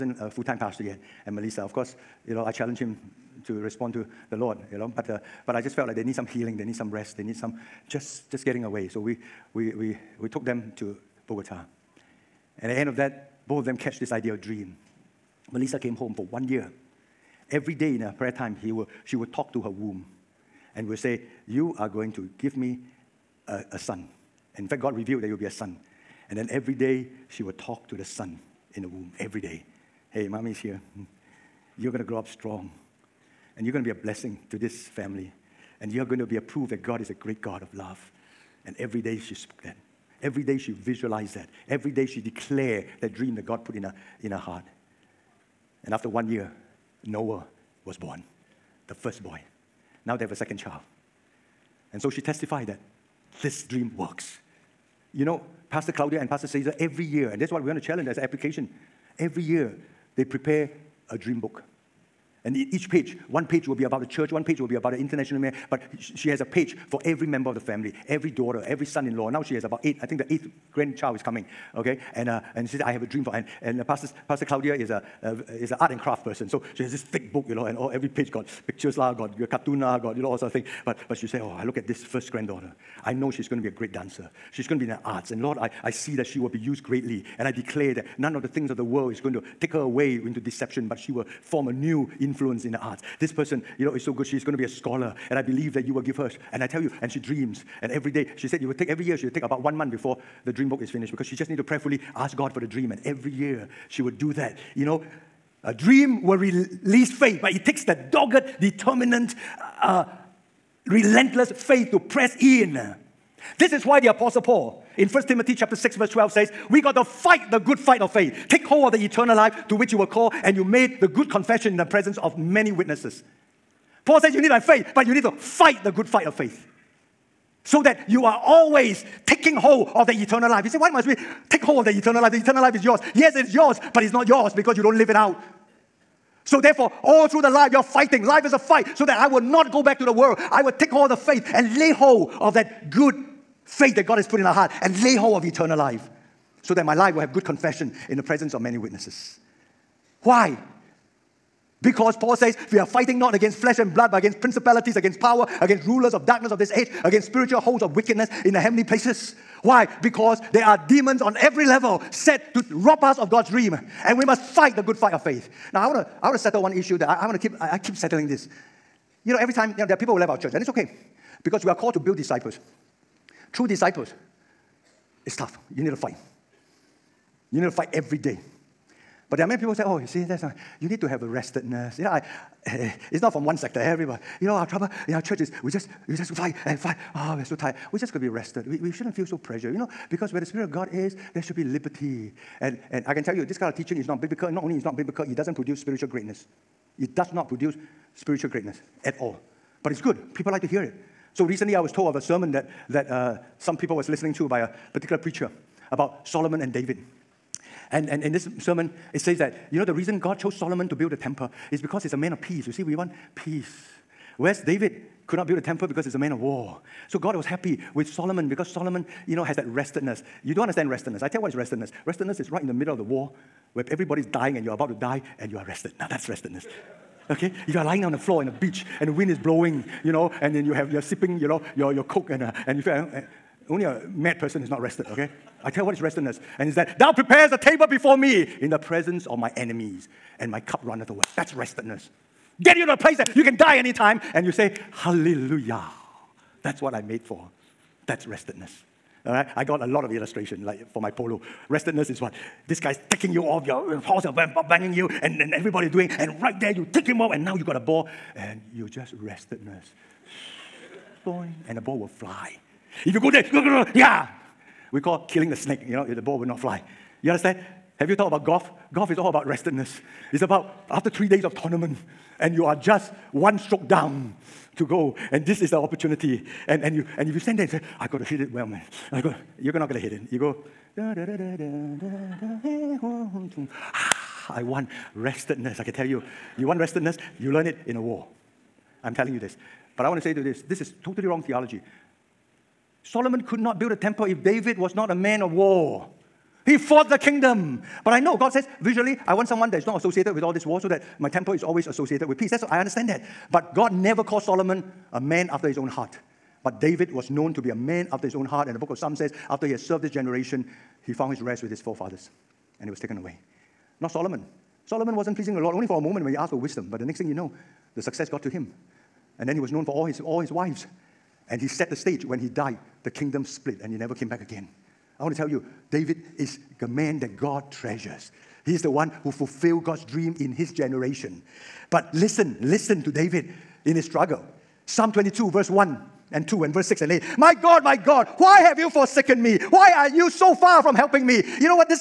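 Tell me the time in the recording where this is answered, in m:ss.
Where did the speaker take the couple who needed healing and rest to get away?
0:11.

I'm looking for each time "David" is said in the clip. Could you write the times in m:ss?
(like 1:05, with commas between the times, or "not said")
3:26, 3:34, 4:54, 5:06, 5:25, 5:33.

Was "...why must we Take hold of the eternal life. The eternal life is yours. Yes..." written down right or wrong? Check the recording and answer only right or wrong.
right.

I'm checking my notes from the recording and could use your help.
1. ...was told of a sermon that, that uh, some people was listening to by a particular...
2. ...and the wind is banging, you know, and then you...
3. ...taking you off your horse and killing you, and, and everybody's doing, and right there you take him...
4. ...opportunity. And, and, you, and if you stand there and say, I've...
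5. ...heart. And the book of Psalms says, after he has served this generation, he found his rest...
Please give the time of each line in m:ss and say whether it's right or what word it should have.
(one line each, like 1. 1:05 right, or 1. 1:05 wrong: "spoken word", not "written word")
1. 3:21 right
2. 3:48 wrong: "blowing", not "banging"
3. 4:13 wrong: "banging", not "killing"
4. 4:35 right
5. 5:08 right.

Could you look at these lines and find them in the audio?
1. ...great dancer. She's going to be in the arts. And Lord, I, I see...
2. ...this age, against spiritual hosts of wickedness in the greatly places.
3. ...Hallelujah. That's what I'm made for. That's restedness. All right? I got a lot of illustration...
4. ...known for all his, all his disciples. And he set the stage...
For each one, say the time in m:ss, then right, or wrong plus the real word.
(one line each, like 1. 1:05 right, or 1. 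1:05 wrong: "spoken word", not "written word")
1. 1:23 right
2. 2:36 wrong: "heavenly", not "greatly"
3. 4:04 right
4. 5:19 wrong: "wives", not "disciples".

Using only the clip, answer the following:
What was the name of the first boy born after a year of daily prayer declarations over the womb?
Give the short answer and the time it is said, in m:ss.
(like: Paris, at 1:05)
Noah, at 0:47.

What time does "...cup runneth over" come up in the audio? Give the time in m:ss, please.
4:00.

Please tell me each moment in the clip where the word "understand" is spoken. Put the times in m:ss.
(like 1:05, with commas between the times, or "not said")
3:40, 4:27, 5:02.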